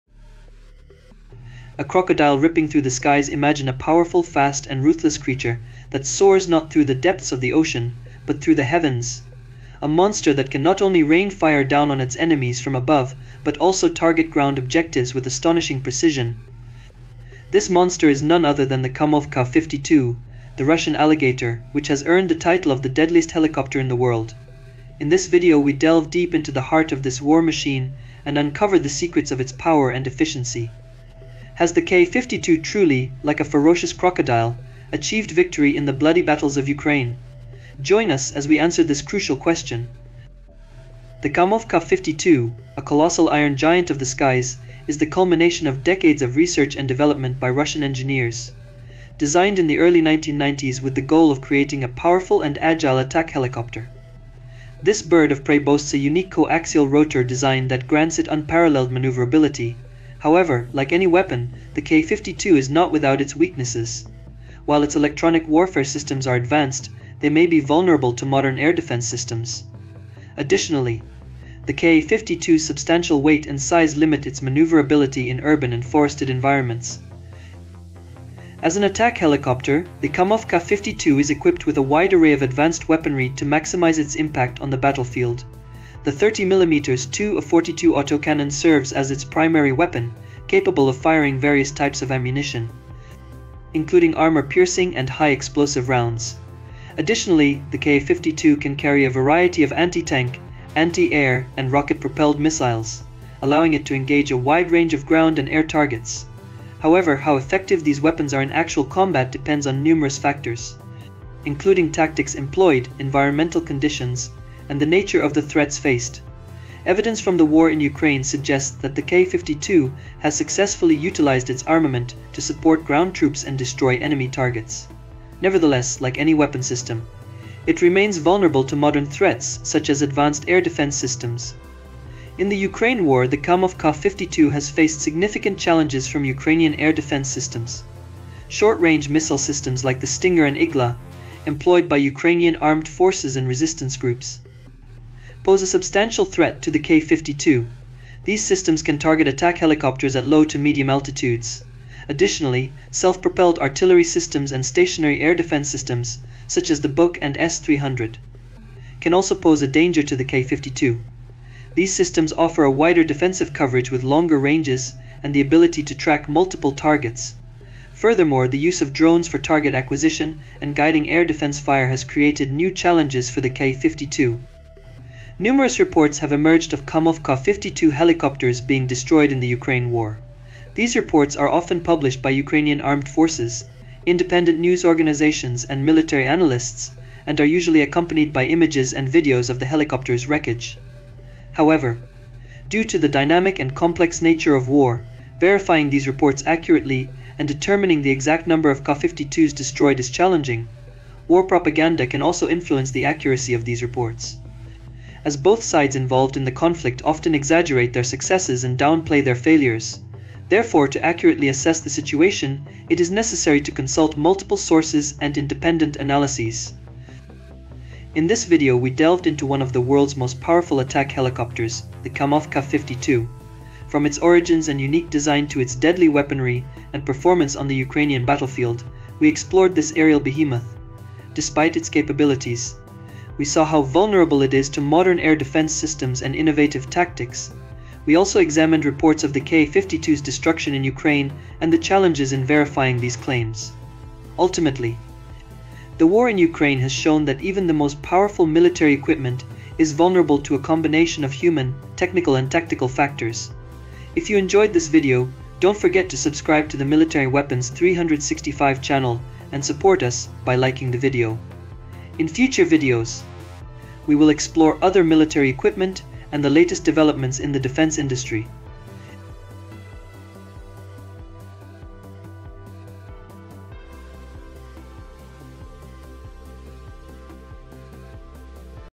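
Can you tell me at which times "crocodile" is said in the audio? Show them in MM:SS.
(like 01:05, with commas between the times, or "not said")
00:01, 00:33.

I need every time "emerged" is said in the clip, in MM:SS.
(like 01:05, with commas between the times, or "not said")
02:56.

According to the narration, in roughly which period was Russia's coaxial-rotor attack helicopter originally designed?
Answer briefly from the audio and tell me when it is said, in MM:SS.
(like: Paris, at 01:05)
early 1990s, at 00:49.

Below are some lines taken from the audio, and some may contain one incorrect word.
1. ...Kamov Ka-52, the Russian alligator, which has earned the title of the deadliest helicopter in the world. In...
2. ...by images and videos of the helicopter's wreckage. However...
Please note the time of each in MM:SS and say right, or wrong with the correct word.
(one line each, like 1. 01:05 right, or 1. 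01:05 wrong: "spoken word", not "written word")
1. 00:18 right
2. 03:08 right.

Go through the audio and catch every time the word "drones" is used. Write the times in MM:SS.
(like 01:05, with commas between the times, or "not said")
02:48.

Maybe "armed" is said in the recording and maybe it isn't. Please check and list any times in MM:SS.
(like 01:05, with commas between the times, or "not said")
02:22, 03:02.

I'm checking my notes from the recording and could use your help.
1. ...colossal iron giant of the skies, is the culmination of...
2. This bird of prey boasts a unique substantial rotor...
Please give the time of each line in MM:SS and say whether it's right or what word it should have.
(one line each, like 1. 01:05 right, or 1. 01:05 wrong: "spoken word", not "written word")
1. 00:42 right
2. 00:54 wrong: "coaxial", not "substantial".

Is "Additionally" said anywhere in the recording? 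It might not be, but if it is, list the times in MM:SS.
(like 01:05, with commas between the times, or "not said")
01:10, 01:36, 02:32.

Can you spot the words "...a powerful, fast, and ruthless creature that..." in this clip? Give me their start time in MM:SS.
00:03.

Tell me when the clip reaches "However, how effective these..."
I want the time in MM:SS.
01:46.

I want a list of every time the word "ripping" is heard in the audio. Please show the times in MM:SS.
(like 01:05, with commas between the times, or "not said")
00:02.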